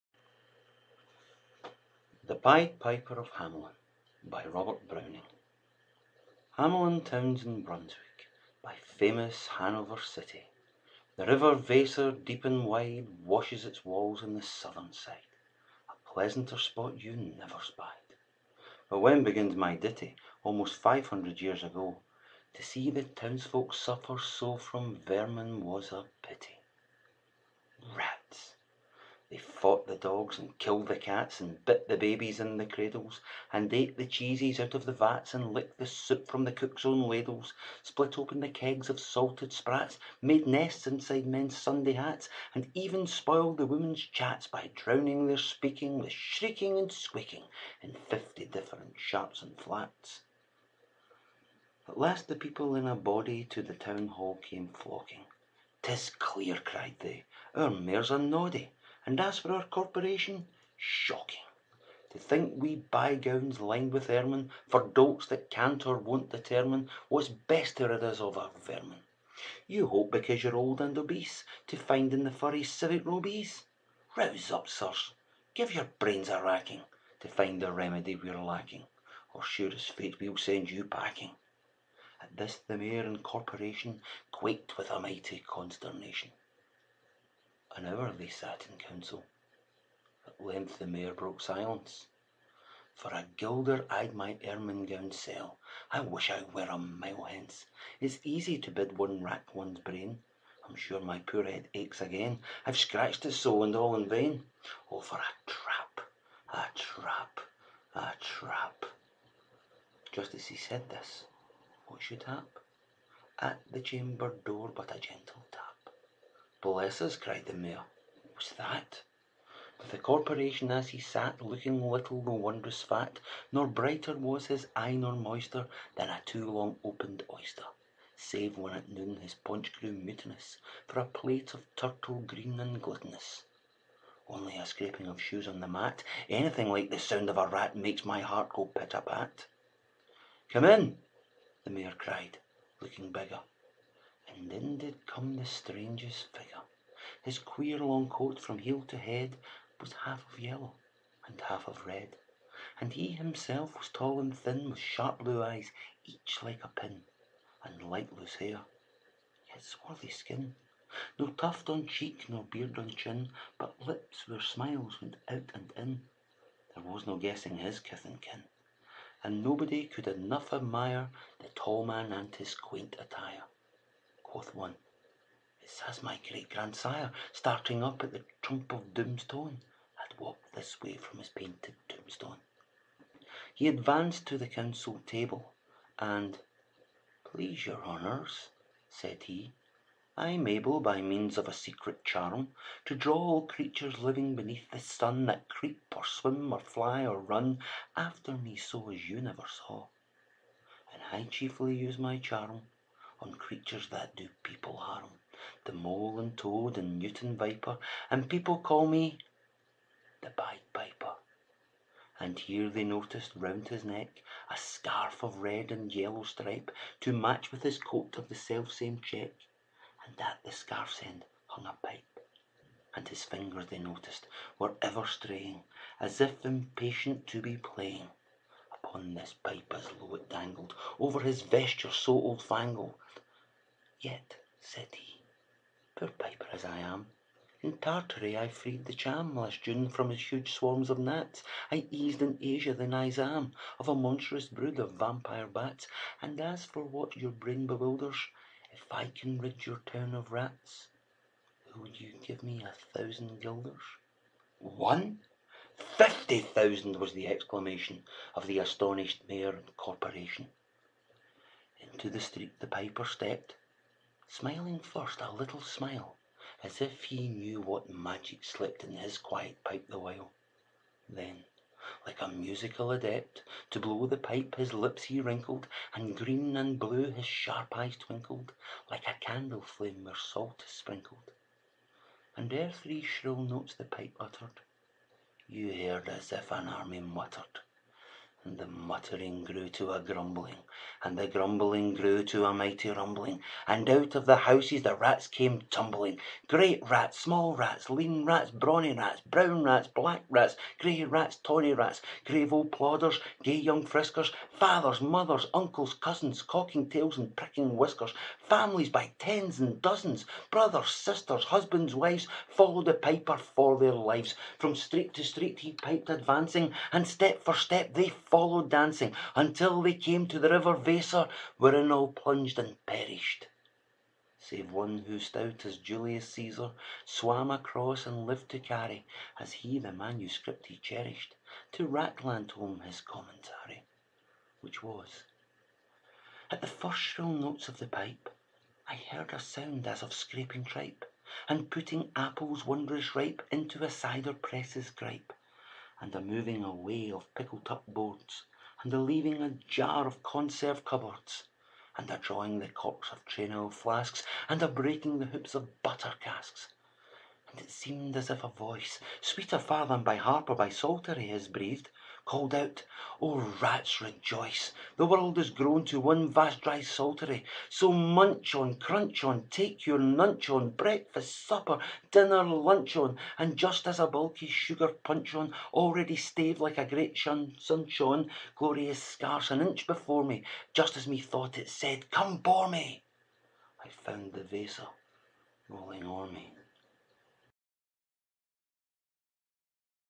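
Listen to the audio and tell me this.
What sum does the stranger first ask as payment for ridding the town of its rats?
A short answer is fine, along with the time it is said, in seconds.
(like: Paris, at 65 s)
1,000 guilders, at 252 s.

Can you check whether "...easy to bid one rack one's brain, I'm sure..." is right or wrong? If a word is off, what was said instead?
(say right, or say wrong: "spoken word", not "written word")
right.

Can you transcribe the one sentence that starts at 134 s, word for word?
Only a scraping of shoes on the mat, Anything like the sound of a rat Makes my heart go pit a pat.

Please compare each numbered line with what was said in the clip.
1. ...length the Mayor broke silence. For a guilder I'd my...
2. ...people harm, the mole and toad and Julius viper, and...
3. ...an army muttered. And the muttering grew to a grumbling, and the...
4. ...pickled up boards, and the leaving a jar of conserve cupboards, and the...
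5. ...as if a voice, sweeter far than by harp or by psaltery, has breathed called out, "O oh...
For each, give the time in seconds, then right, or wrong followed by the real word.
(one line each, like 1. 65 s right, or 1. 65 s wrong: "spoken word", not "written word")
1. 90 s right
2. 204 s wrong: "Newton", not "Julius"
3. 286 s right
4. 347 s right
5. 358 s right.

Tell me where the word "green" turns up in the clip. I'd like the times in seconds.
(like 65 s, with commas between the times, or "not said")
132 s, 276 s.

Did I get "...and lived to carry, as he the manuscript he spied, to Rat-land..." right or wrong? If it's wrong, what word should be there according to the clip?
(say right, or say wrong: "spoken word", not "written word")
wrong: "cherished", not "spied".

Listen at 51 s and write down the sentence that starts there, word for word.
At last the people in a body to the town hall came flocking.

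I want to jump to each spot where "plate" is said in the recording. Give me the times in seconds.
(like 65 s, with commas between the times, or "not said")
131 s.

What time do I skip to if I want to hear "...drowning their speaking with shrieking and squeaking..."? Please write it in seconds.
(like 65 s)
44 s.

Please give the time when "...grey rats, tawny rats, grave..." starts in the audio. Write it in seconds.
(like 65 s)
300 s.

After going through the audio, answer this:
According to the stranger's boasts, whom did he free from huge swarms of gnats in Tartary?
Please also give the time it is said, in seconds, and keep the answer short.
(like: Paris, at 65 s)
the Cham, at 238 s.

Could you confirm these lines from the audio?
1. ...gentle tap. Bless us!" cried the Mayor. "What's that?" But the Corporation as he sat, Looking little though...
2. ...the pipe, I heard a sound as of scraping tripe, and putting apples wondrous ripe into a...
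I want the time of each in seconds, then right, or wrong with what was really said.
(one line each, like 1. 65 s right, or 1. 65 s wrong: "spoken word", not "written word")
1. 114 s right
2. 337 s right.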